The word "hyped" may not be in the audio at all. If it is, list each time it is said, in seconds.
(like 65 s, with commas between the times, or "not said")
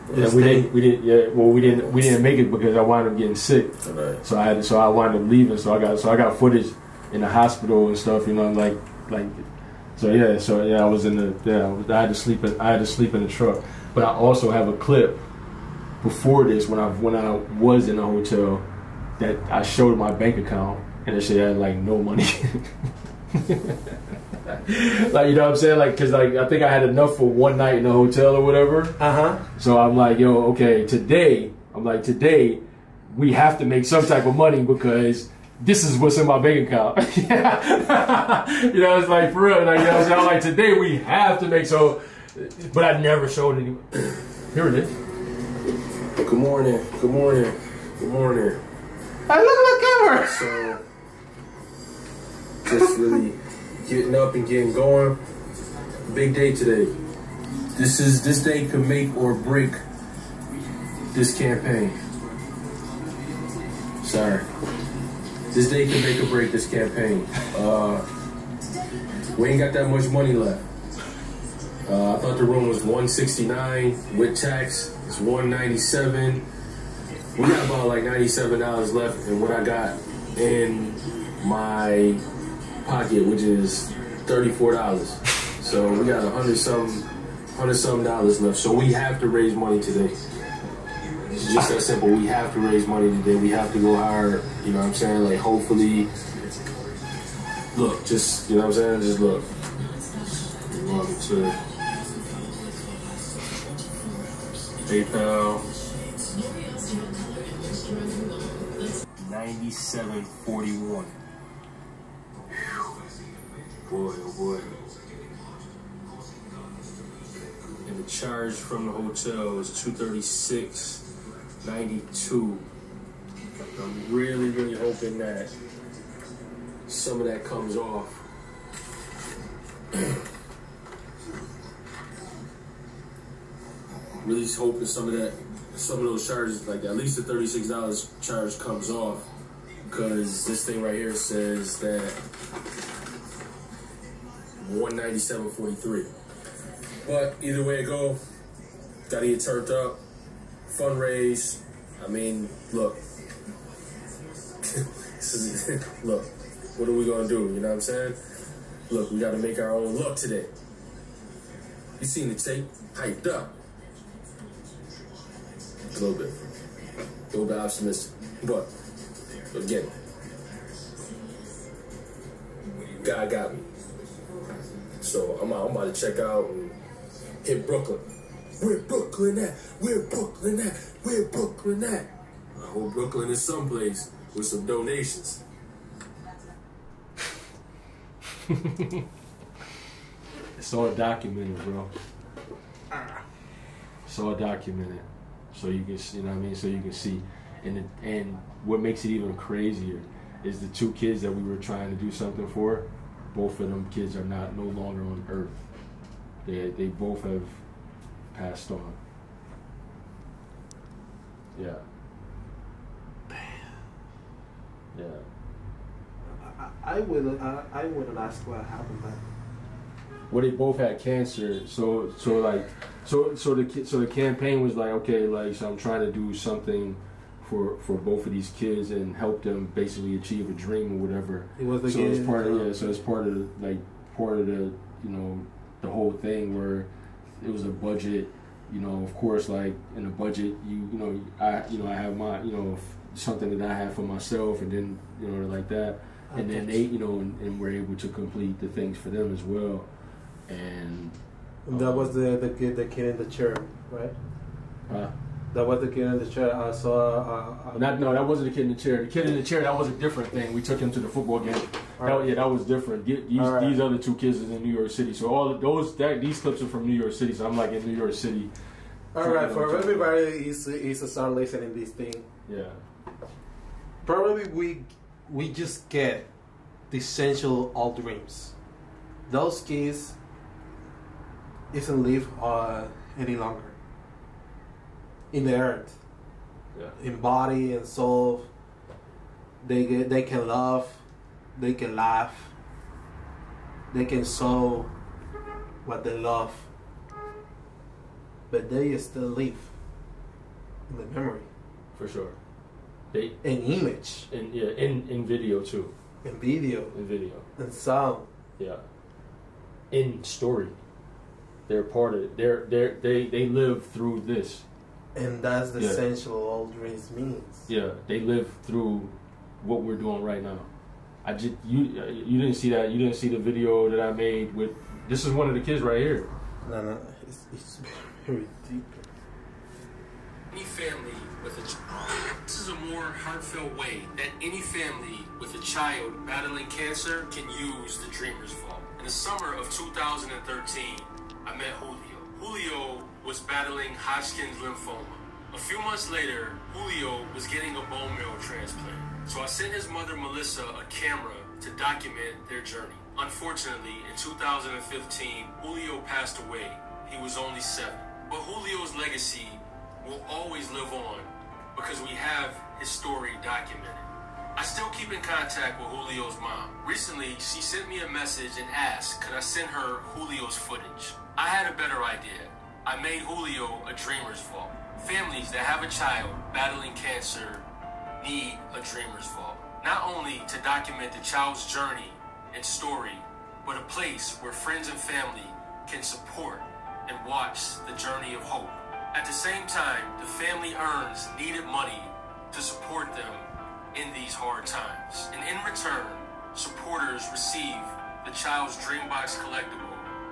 162 s.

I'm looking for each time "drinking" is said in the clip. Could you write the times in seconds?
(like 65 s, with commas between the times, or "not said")
not said.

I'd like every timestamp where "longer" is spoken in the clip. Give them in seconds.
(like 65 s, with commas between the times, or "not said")
204 s, 283 s.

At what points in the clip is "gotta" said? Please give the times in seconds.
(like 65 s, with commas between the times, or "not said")
149 s, 159 s.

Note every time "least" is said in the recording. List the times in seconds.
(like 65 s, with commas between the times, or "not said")
136 s.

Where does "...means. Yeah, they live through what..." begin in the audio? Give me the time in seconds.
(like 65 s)
317 s.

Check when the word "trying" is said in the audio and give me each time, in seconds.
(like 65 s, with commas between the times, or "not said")
201 s, 225 s.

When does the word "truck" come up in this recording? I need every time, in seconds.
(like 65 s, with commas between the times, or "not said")
13 s.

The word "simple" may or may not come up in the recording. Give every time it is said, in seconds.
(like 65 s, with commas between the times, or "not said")
91 s.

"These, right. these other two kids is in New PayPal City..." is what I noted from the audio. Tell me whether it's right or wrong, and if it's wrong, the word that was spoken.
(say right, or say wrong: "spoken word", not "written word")
wrong: "York", not "PayPal".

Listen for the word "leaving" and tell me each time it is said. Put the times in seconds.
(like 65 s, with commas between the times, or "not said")
5 s.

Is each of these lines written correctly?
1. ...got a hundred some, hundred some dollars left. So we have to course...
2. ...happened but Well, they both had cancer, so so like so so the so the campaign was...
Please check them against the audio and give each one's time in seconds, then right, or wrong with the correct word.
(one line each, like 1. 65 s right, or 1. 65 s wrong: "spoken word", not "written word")
1. 86 s wrong: "raise", not "course"
2. 218 s right.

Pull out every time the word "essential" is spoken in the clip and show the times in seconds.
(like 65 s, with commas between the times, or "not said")
276 s, 315 s.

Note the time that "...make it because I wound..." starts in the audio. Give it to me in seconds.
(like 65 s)
2 s.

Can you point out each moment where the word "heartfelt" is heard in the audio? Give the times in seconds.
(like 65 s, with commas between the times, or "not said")
333 s.